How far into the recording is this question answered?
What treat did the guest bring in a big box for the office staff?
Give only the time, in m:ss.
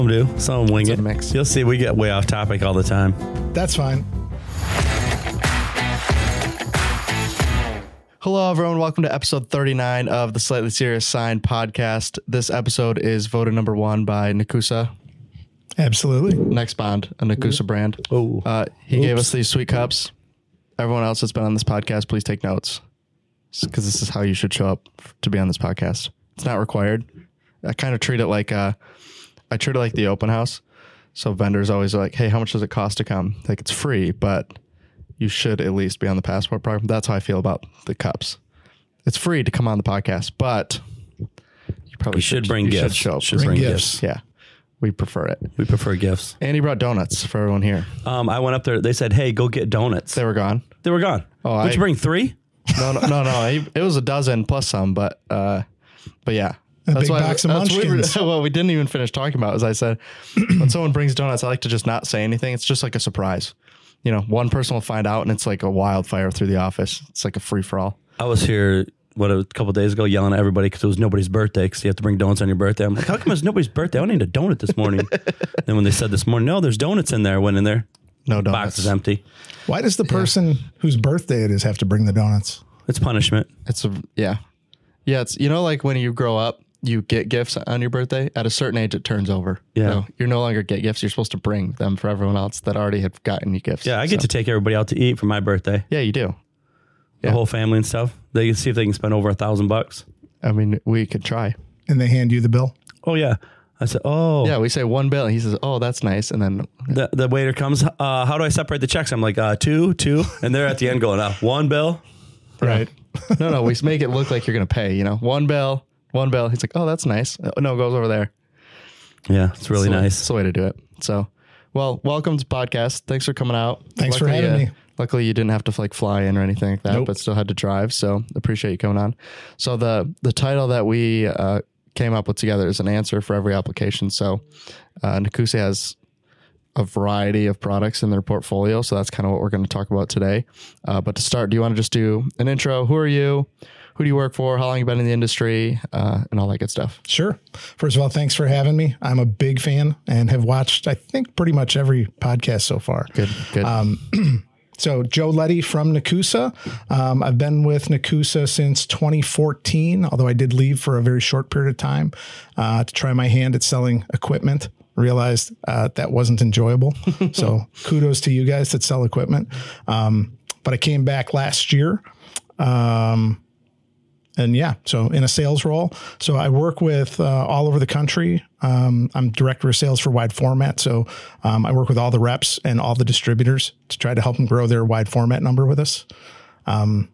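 0:57.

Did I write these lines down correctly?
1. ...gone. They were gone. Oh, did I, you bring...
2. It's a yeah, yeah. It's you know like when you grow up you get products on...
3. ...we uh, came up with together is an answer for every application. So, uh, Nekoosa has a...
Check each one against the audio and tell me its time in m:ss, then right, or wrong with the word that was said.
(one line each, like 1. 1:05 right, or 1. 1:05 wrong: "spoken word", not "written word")
1. 0:50 right
2. 1:23 wrong: "gifts", not "products"
3. 2:10 right.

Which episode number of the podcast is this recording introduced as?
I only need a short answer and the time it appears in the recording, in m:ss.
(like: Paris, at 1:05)
39, at 0:09.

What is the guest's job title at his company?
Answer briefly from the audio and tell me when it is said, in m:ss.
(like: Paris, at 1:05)
Director of sales for wide format, at 2:59.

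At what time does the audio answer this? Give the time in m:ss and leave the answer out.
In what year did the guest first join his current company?
2:38.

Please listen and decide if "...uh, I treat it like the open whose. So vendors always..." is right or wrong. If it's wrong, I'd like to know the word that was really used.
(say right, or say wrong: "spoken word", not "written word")
wrong: "house", not "whose".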